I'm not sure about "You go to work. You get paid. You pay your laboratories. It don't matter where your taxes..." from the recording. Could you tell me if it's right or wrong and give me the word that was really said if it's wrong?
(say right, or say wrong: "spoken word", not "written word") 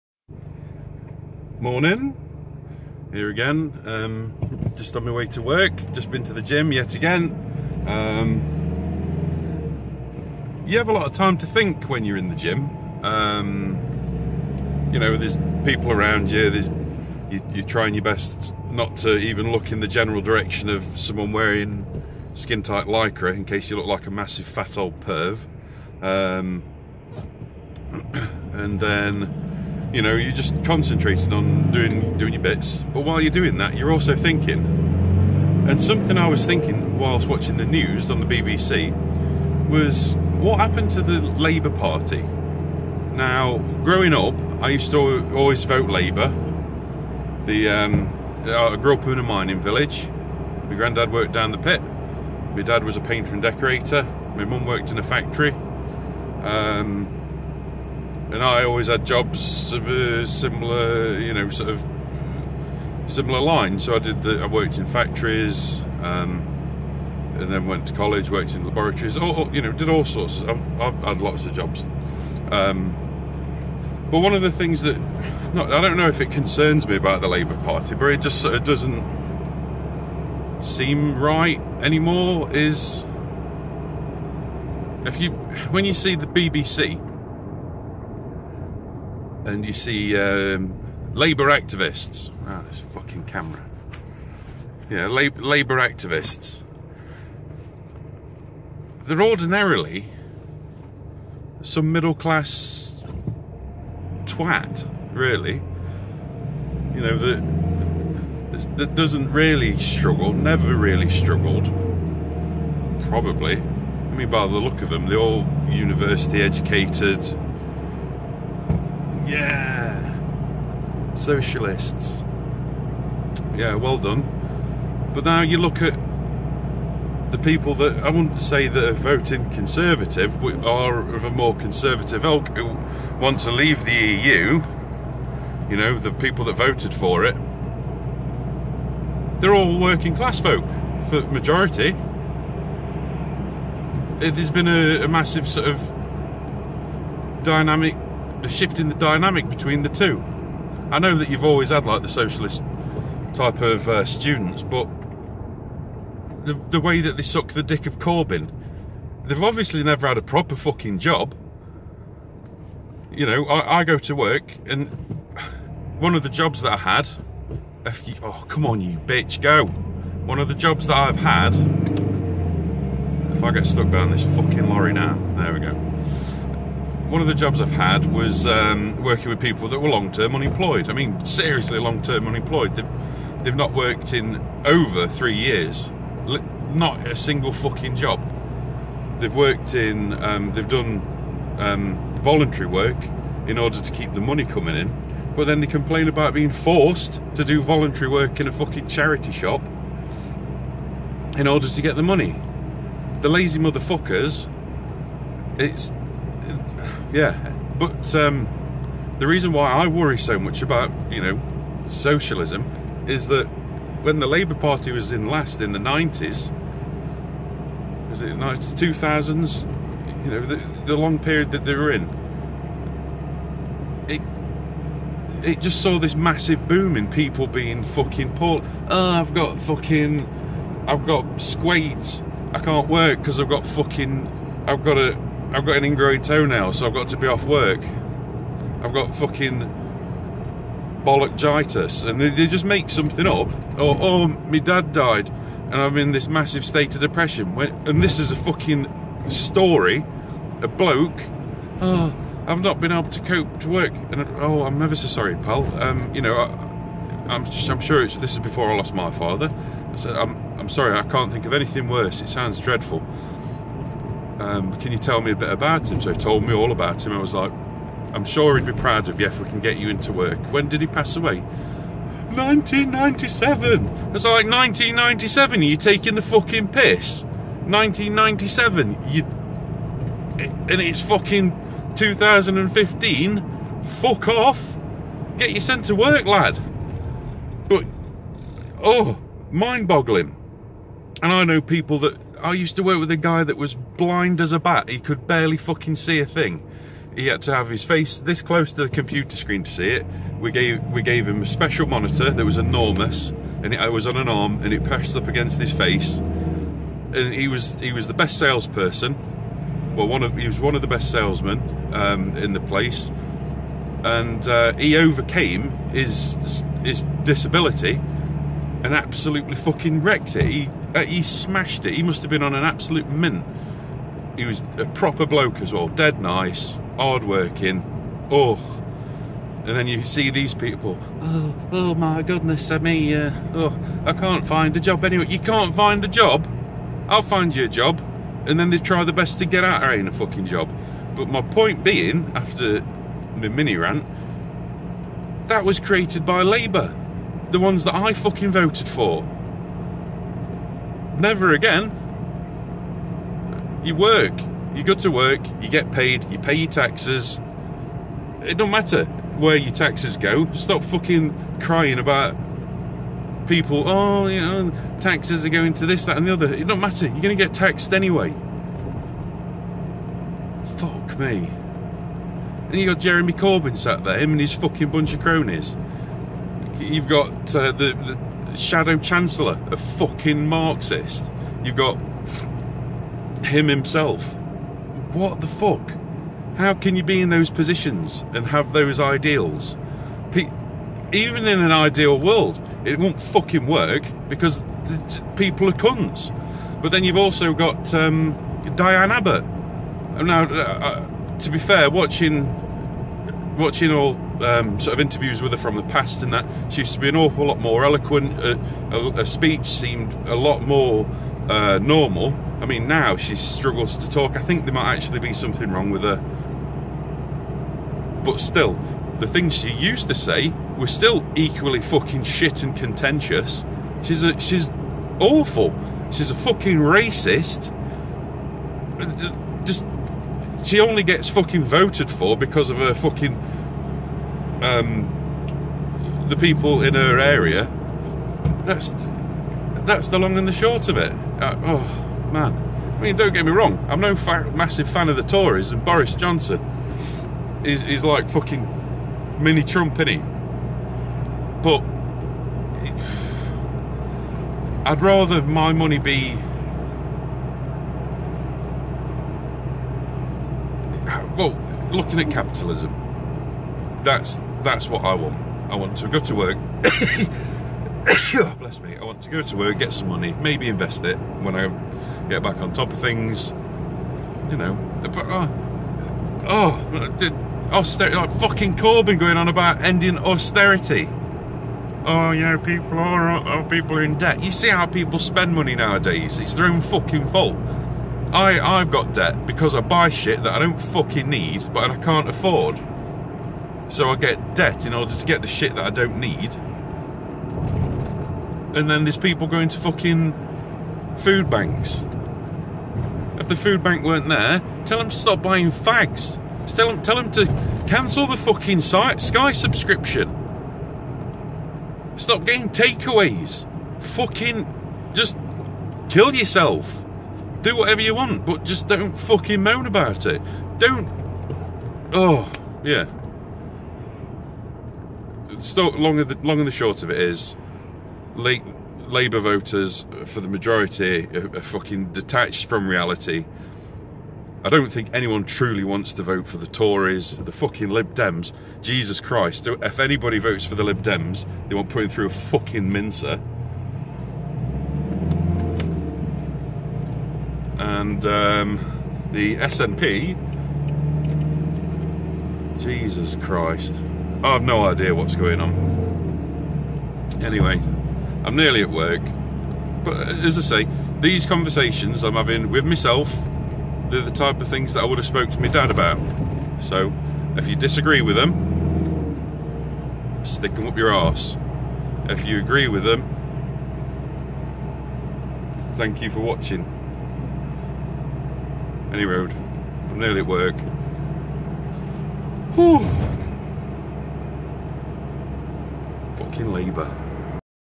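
wrong: "taxes", not "laboratories".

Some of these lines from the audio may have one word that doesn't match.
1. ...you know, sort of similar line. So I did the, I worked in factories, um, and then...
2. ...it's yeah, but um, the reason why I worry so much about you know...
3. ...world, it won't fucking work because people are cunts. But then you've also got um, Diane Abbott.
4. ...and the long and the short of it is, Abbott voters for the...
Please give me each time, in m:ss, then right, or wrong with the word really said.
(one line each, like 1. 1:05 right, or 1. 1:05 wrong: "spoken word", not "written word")
1. 1:01 right
2. 3:25 right
3. 6:32 right
4. 8:46 wrong: "Labour", not "Abbott".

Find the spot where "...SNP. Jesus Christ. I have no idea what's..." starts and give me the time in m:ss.
9:09.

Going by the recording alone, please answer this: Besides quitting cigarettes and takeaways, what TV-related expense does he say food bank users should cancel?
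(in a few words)
Sky subscription.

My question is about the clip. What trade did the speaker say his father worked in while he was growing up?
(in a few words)
painter and decorator.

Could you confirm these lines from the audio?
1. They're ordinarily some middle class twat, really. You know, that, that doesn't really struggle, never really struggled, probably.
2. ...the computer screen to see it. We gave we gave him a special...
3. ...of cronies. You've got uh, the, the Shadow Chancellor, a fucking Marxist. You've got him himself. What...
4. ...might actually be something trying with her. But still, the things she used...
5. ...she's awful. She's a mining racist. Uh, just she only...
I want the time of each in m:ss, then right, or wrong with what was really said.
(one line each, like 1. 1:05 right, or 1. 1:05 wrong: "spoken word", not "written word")
1. 1:39 right
2. 4:58 right
3. 6:15 right
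4. 6:54 wrong: "wrong", not "trying"
5. 7:04 wrong: "fucking", not "mining".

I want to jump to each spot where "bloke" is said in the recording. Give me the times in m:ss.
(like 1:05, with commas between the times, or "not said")
4:10, 5:25.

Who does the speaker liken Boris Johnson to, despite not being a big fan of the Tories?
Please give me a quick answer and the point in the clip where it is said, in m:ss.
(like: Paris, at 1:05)
mini Trump, at 7:29.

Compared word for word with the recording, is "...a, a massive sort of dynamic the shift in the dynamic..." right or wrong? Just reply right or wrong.
right.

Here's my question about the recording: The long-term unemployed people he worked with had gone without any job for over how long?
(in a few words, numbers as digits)
3 years.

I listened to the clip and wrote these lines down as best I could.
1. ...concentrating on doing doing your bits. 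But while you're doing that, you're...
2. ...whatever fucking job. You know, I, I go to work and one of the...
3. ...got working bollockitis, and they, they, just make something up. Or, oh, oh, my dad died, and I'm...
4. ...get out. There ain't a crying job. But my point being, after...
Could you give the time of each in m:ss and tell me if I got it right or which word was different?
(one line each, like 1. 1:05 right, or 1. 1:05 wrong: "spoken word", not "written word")
1. 0:30 right
2. 2:40 wrong: "proper", not "whatever"
3. 3:58 wrong: "fucking", not "working"
4. 5:39 wrong: "fucking", not "crying".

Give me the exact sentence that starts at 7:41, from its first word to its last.
Well, looking at capitalism, that's that's what I want.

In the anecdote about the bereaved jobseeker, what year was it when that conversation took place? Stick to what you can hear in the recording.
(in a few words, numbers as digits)
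2015.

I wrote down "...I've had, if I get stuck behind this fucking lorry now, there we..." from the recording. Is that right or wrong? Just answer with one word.
right.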